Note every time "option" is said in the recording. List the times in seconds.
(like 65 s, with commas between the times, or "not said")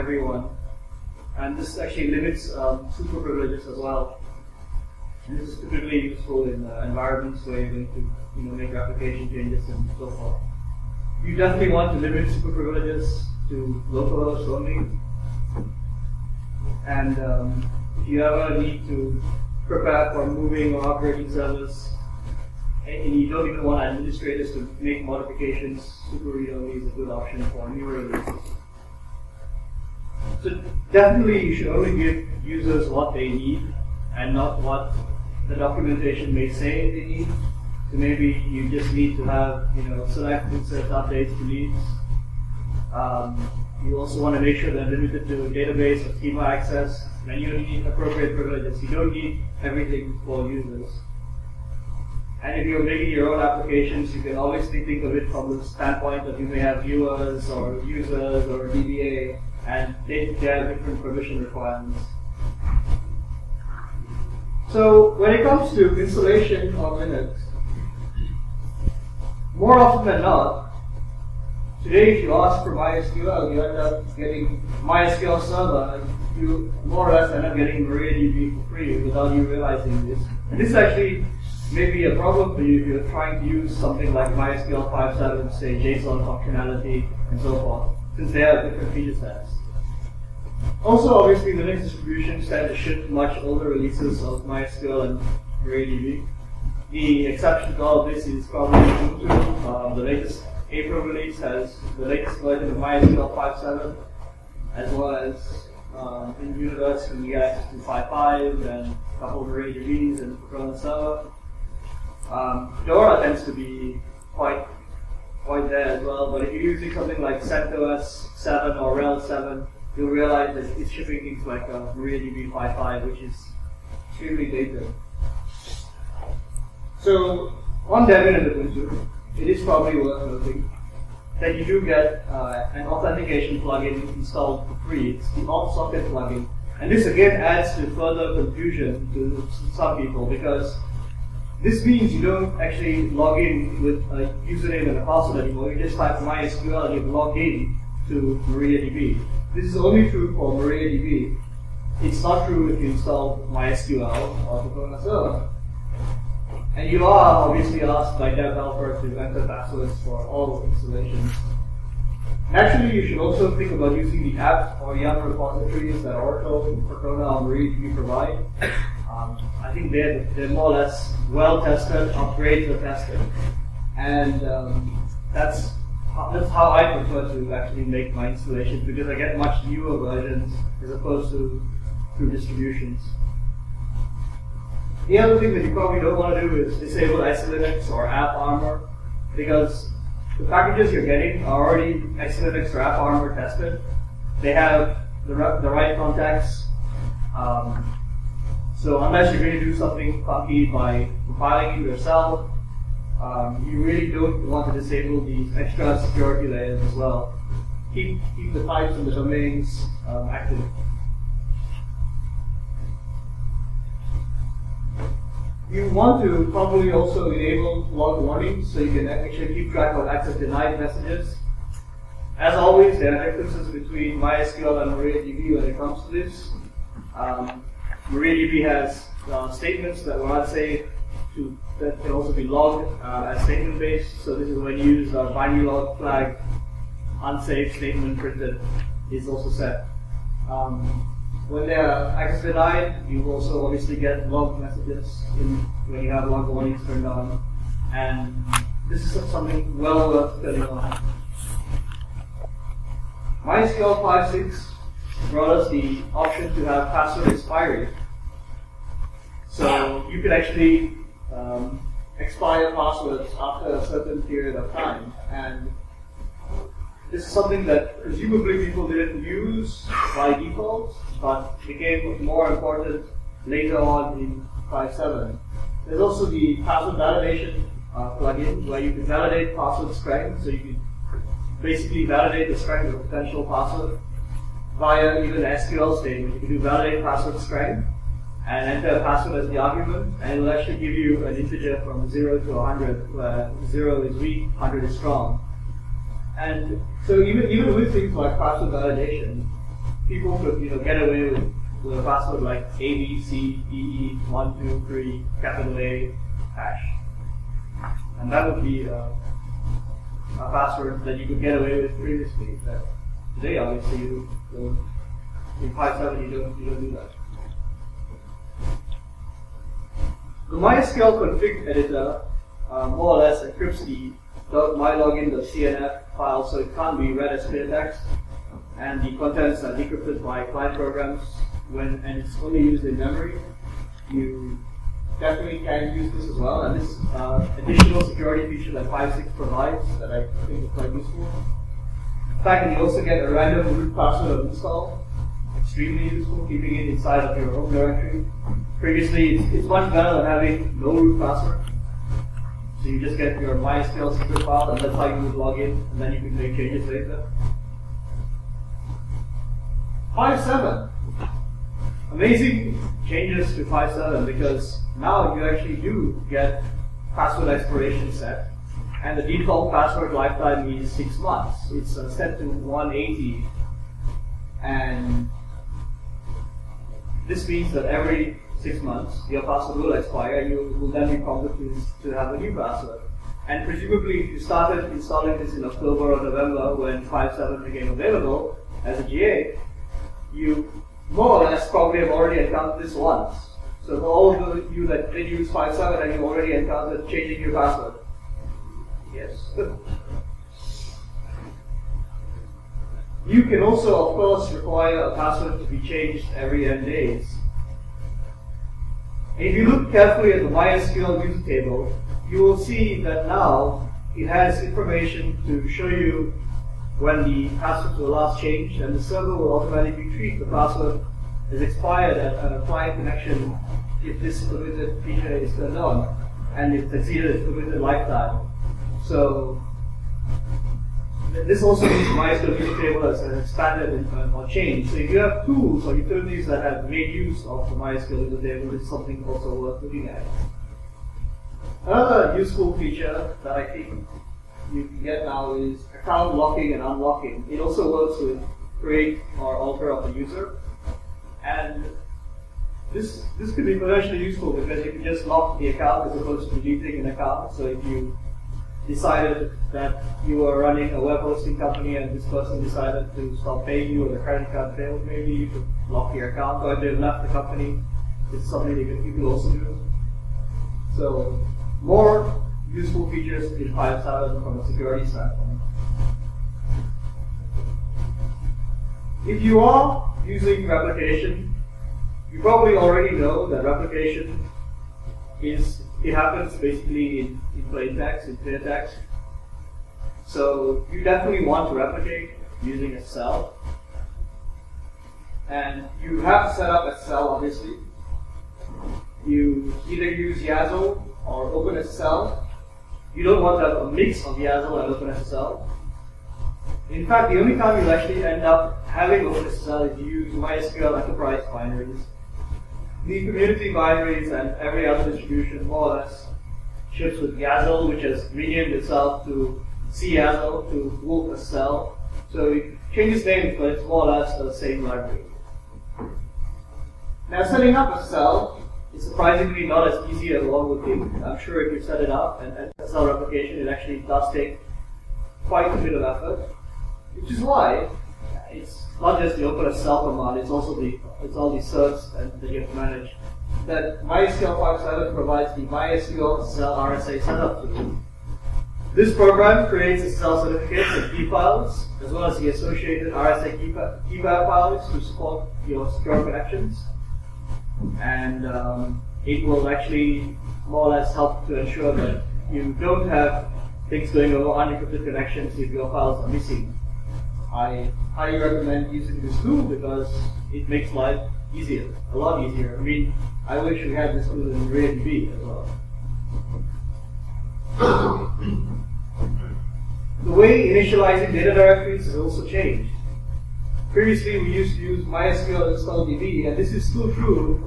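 27 s, 256 s.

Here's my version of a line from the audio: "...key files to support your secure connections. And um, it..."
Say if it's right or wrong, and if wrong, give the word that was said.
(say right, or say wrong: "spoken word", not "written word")
right.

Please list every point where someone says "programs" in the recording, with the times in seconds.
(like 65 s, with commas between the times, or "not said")
330 s, 549 s.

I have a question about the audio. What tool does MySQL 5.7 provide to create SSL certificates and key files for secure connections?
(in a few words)
MySQL SSL RSA setup.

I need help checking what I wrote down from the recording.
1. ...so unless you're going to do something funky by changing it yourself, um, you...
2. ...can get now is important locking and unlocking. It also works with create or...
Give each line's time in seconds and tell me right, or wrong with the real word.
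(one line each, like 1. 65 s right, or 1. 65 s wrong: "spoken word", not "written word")
1. 198 s wrong: "compiling", not "changing"
2. 444 s wrong: "account", not "important".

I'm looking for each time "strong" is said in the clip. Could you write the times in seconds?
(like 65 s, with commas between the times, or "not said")
294 s.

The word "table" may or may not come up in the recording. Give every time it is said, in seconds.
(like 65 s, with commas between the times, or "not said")
411 s, 438 s.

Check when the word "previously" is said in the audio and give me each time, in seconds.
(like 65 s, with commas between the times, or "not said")
311 s, 348 s, 583 s.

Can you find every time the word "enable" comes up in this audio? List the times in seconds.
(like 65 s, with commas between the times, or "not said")
217 s.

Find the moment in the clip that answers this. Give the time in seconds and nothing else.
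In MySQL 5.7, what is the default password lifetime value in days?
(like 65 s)
372 s.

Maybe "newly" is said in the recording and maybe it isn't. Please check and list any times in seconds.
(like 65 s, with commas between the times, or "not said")
not said.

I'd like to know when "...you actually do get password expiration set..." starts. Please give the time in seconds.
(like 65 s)
365 s.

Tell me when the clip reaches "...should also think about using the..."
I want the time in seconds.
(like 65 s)
163 s.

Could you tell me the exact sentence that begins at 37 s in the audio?
So maybe you just need to have, you know, select and set updates to needs.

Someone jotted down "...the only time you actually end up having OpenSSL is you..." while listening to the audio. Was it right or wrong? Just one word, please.
right.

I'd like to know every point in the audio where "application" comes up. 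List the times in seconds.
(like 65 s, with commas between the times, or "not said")
8 s, 53 s.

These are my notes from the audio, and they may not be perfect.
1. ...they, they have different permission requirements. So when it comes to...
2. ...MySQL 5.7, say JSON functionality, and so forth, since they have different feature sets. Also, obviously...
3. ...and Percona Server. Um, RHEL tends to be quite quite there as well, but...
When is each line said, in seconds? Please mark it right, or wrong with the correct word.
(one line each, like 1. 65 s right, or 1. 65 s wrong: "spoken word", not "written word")
1. 60 s right
2. 84 s right
3. 110 s wrong: "Fedora", not "RHEL".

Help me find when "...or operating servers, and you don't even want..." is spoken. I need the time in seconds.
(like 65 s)
20 s.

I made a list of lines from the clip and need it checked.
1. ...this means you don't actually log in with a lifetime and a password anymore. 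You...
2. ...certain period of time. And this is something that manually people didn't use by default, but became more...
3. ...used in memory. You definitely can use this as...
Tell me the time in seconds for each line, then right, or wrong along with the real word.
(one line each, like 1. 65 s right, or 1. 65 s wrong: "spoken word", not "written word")
1. 141 s wrong: "username", not "lifetime"
2. 263 s wrong: "presumably", not "manually"
3. 332 s right.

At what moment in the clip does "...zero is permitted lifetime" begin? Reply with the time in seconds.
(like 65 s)
427 s.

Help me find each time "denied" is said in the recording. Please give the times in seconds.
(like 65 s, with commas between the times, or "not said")
220 s, 242 s.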